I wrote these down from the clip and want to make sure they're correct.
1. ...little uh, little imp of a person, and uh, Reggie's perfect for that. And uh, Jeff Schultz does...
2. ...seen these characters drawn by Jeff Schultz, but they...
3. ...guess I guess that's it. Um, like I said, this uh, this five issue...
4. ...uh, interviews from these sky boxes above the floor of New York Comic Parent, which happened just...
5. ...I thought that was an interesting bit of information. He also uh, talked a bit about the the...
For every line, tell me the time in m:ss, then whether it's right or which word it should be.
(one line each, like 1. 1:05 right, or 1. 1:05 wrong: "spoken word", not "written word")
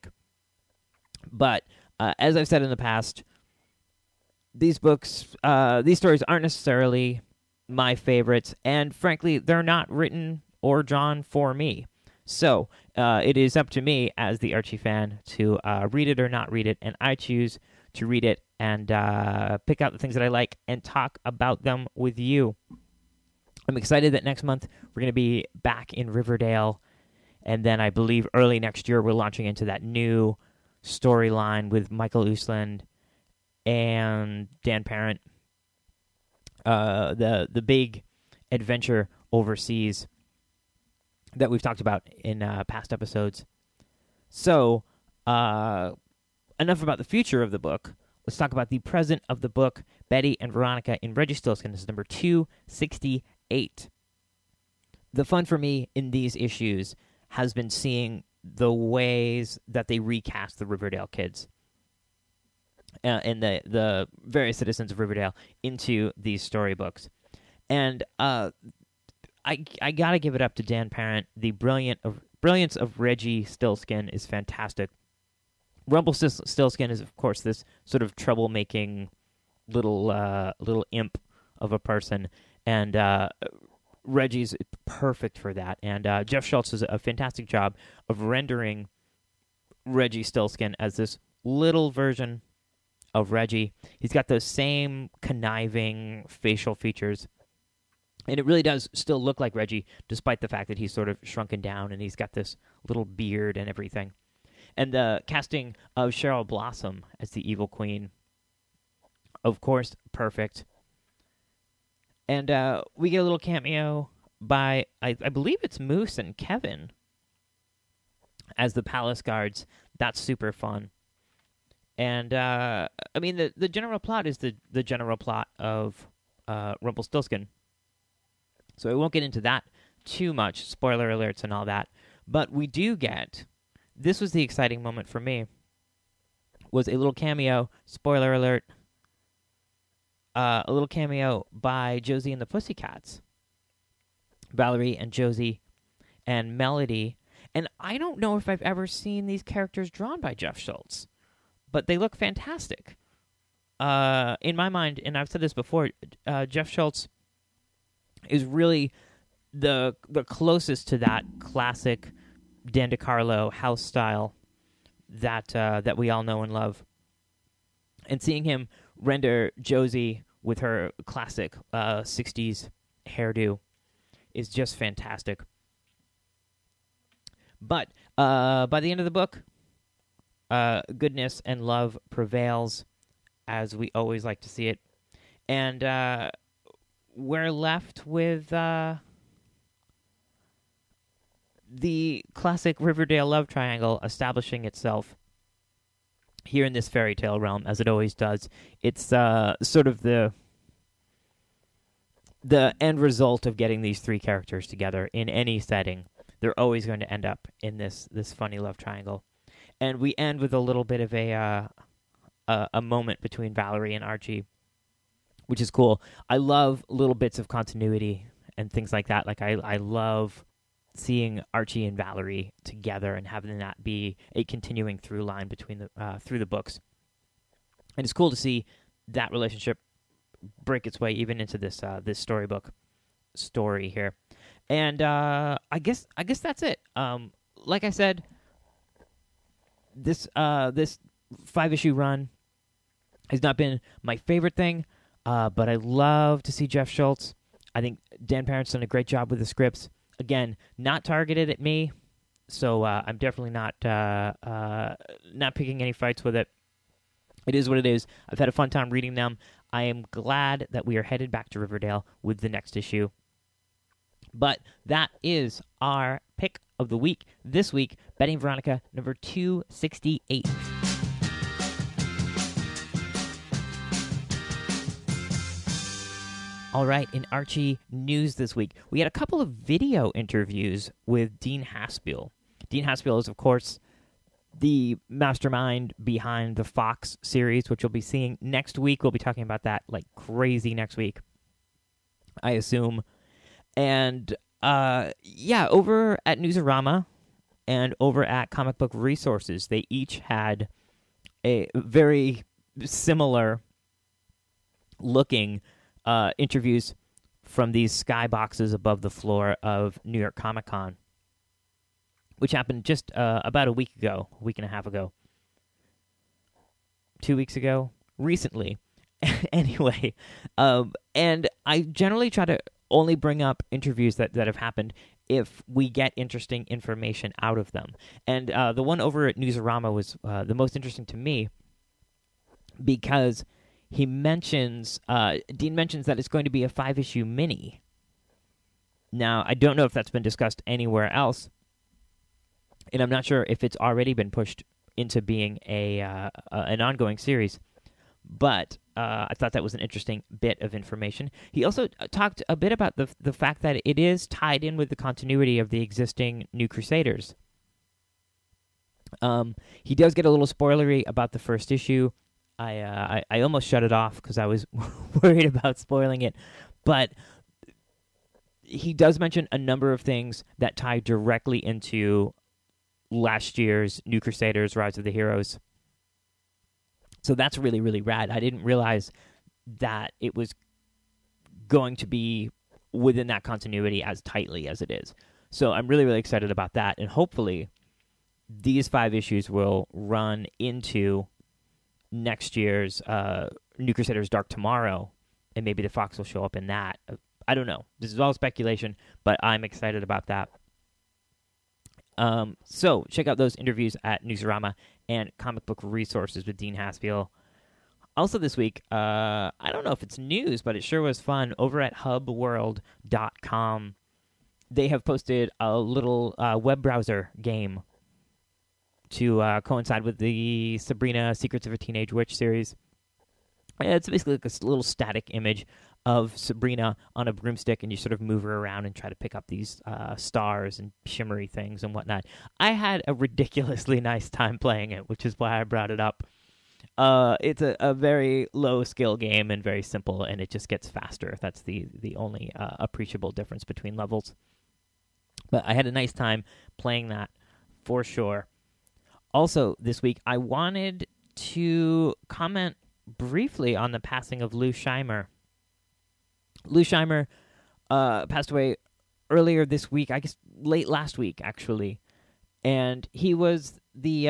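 1. 1:19 right
2. 2:28 right
3. 3:55 right
4. 5:06 wrong: "Con", not "Parent"
5. 5:49 right.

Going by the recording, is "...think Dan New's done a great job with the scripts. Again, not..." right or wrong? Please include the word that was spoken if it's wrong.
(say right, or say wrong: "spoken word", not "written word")
wrong: "Parent", not "New".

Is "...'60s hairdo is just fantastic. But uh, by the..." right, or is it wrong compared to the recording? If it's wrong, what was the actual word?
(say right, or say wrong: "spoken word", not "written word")
right.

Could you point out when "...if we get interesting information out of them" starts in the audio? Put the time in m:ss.
5:25.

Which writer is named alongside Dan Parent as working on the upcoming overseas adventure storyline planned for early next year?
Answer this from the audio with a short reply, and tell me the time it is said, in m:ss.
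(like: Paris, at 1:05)
Michael Uslan, at 0:31.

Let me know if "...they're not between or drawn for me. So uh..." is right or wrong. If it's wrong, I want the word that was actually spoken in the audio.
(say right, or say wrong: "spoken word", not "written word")
wrong: "written", not "between".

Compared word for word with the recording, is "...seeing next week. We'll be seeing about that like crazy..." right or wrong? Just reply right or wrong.
wrong.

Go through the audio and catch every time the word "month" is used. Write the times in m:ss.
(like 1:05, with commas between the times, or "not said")
0:24.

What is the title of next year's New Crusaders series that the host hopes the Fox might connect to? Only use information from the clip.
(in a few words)
New Crusaders Dark Tomorrow.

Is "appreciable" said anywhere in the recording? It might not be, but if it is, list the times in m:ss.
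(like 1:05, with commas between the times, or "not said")
7:22.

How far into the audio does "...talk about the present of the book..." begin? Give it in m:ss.
0:48.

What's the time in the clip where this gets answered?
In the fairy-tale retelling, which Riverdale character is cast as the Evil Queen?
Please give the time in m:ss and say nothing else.
1:46.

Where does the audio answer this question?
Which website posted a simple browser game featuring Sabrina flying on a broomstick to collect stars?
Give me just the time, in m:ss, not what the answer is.
6:51.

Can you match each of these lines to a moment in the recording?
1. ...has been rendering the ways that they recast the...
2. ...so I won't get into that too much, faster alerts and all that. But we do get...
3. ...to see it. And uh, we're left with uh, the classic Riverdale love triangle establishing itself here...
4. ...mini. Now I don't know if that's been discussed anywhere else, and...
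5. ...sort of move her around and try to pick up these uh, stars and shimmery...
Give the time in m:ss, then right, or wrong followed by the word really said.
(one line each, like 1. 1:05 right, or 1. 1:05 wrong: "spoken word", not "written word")
1. 0:57 wrong: "seeing", not "rendering"
2. 2:08 wrong: "spoiler", not "faster"
3. 3:04 right
4. 5:37 right
5. 7:07 right.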